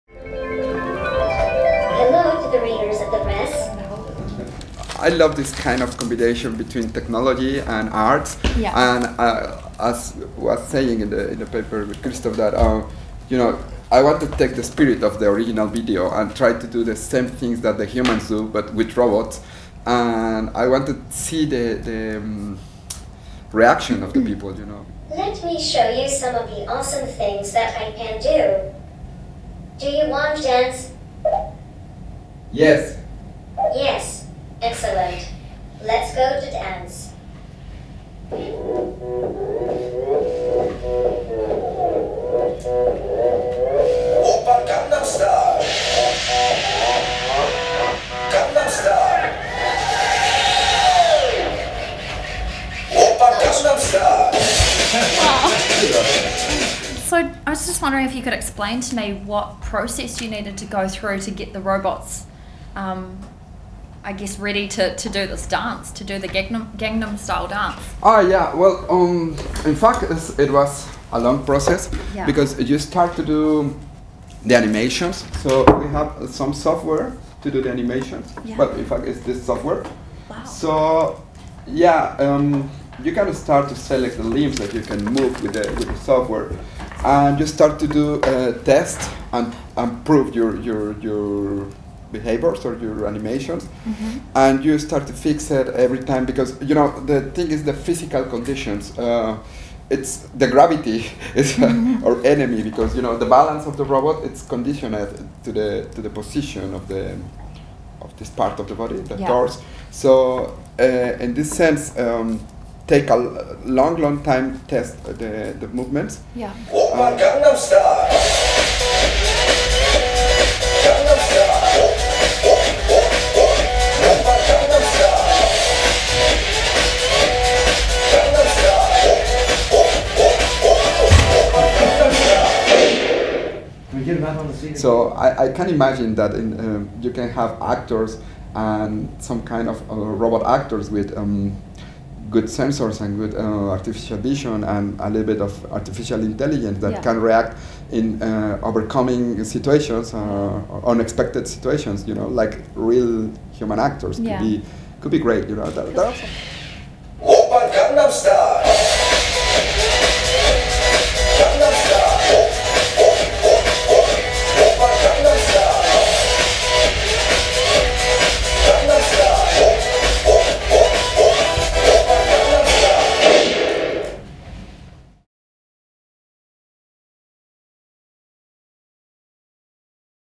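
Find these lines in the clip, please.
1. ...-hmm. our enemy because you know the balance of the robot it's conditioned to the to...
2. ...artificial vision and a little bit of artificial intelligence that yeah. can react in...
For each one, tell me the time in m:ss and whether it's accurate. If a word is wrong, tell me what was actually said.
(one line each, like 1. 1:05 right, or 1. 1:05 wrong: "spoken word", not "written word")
1. 1:41 right
2. 2:23 right.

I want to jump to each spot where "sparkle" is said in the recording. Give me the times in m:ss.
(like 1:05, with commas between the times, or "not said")
not said.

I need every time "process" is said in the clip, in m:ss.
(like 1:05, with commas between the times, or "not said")
0:59, 1:11.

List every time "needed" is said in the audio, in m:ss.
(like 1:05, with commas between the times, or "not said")
1:00.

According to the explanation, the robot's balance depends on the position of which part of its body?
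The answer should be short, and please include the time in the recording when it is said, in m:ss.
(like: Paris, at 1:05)
Torso, at 1:49.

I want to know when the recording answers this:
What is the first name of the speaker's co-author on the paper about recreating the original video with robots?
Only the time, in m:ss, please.
0:12.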